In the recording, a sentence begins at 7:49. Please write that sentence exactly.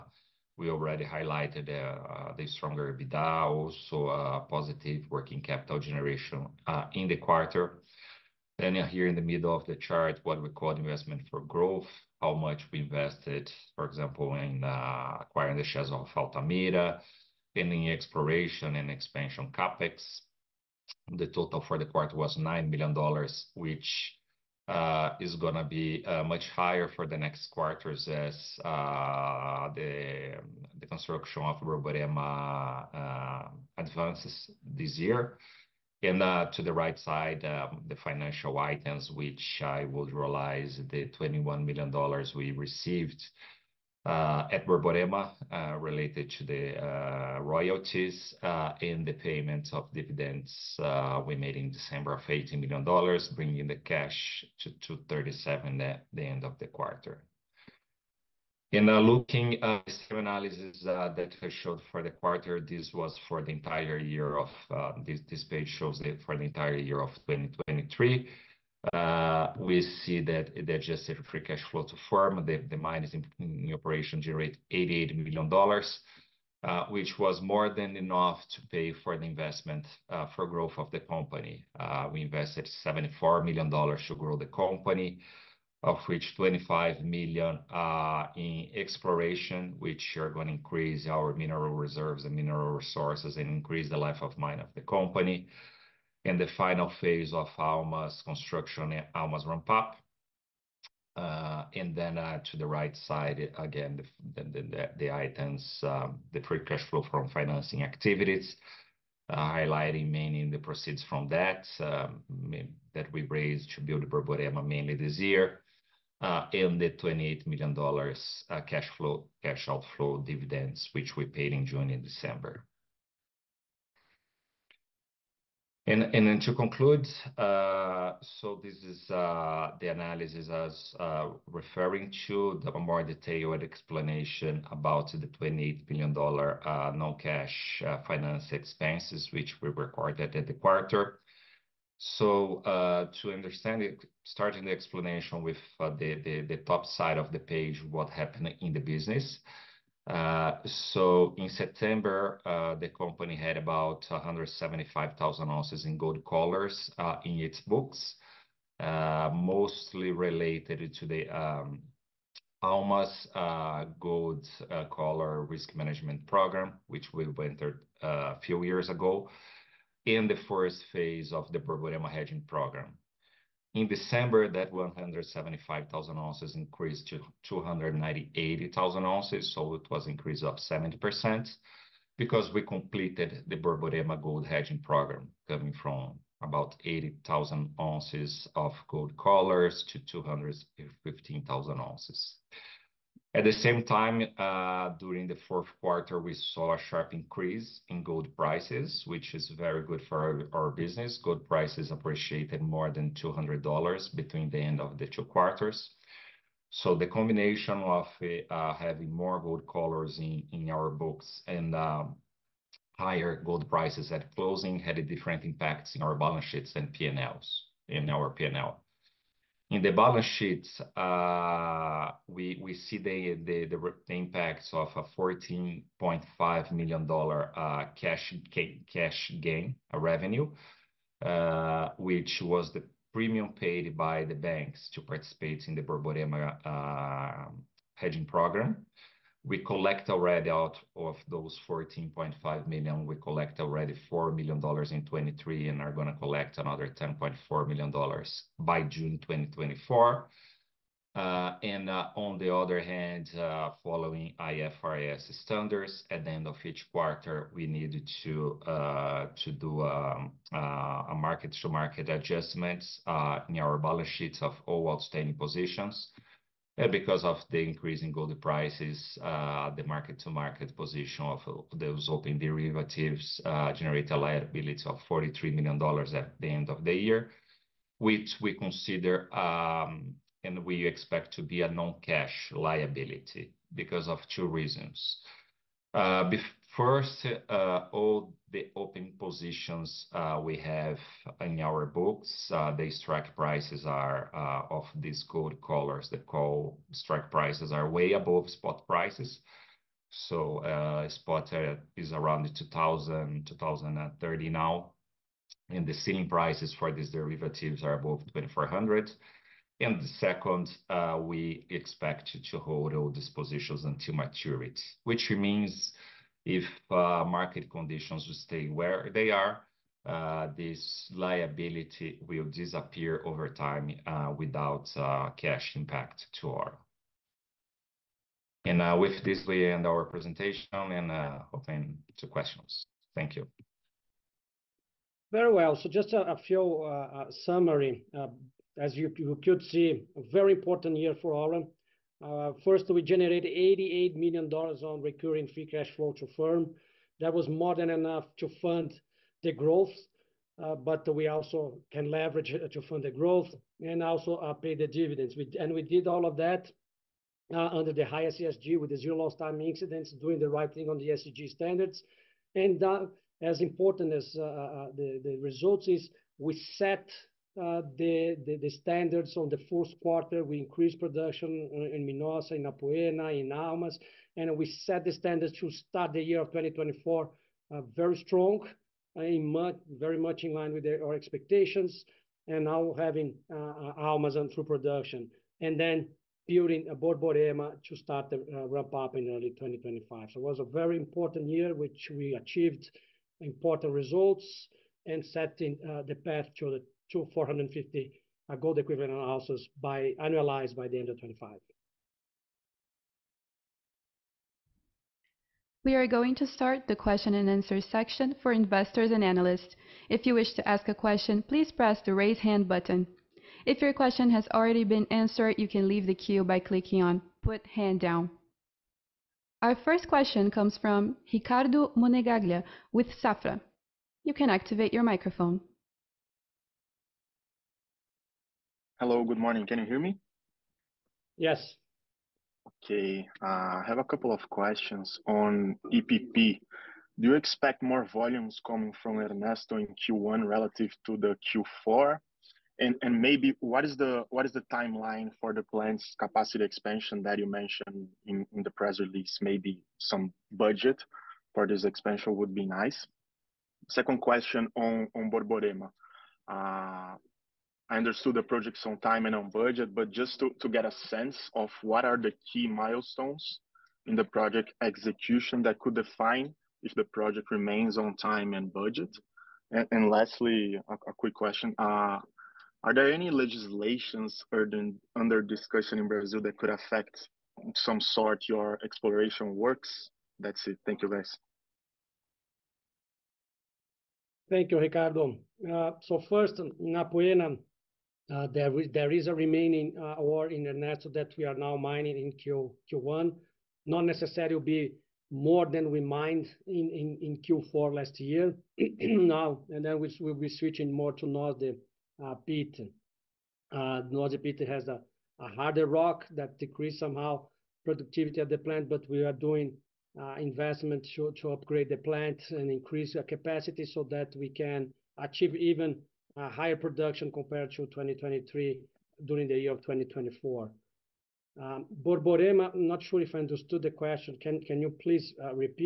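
And, and lastly, a, a, quick question.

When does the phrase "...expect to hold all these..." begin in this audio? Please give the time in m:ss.
5:11.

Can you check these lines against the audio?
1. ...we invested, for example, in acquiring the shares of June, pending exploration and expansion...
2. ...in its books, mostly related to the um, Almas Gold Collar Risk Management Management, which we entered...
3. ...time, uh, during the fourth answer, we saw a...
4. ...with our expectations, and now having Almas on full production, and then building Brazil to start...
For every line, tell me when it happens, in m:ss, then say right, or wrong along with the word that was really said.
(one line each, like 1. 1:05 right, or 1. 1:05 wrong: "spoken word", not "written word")
1. 0:12 wrong: "Altamira", not "June"
2. 2:37 wrong: "Program", not "Management"
3. 3:13 wrong: "quarter", not "answer"
4. 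6:20 wrong: "Borborema", not "Brazil".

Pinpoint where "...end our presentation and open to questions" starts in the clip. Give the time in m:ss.
5:29.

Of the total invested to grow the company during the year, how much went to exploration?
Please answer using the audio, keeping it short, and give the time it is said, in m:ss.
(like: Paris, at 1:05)
$25 million, at 1:26.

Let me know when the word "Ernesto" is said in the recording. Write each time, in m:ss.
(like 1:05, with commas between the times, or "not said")
7:19, 8:10.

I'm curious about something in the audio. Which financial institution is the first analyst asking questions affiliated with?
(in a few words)
Safra.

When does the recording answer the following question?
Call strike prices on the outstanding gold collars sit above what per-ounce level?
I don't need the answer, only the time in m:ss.
5:08.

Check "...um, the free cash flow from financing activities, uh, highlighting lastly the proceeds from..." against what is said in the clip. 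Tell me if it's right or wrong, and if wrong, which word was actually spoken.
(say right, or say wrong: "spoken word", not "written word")
wrong: "mainly", not "lastly".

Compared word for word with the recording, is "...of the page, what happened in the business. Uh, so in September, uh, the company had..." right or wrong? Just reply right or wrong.
right.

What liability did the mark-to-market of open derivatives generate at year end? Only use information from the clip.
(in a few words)
$43 million.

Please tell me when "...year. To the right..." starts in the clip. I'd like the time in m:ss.
0:34.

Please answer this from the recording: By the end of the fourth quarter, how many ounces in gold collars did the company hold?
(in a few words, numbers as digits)
298,000 ounces.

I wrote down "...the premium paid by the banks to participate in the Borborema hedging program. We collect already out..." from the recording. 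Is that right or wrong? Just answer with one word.
right.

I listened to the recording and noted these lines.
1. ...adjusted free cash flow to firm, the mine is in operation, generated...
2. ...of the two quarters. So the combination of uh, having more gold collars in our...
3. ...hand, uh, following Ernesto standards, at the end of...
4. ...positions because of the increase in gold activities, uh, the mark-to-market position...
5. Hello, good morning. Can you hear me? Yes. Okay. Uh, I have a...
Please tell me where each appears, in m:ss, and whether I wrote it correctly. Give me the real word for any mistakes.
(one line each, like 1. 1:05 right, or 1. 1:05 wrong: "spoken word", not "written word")
1. 1:10 right
2. 3:24 right
3. 4:12 wrong: "IFRS", not "Ernesto"
4. 4:25 wrong: "prices", not "activities"
5. 7:09 right.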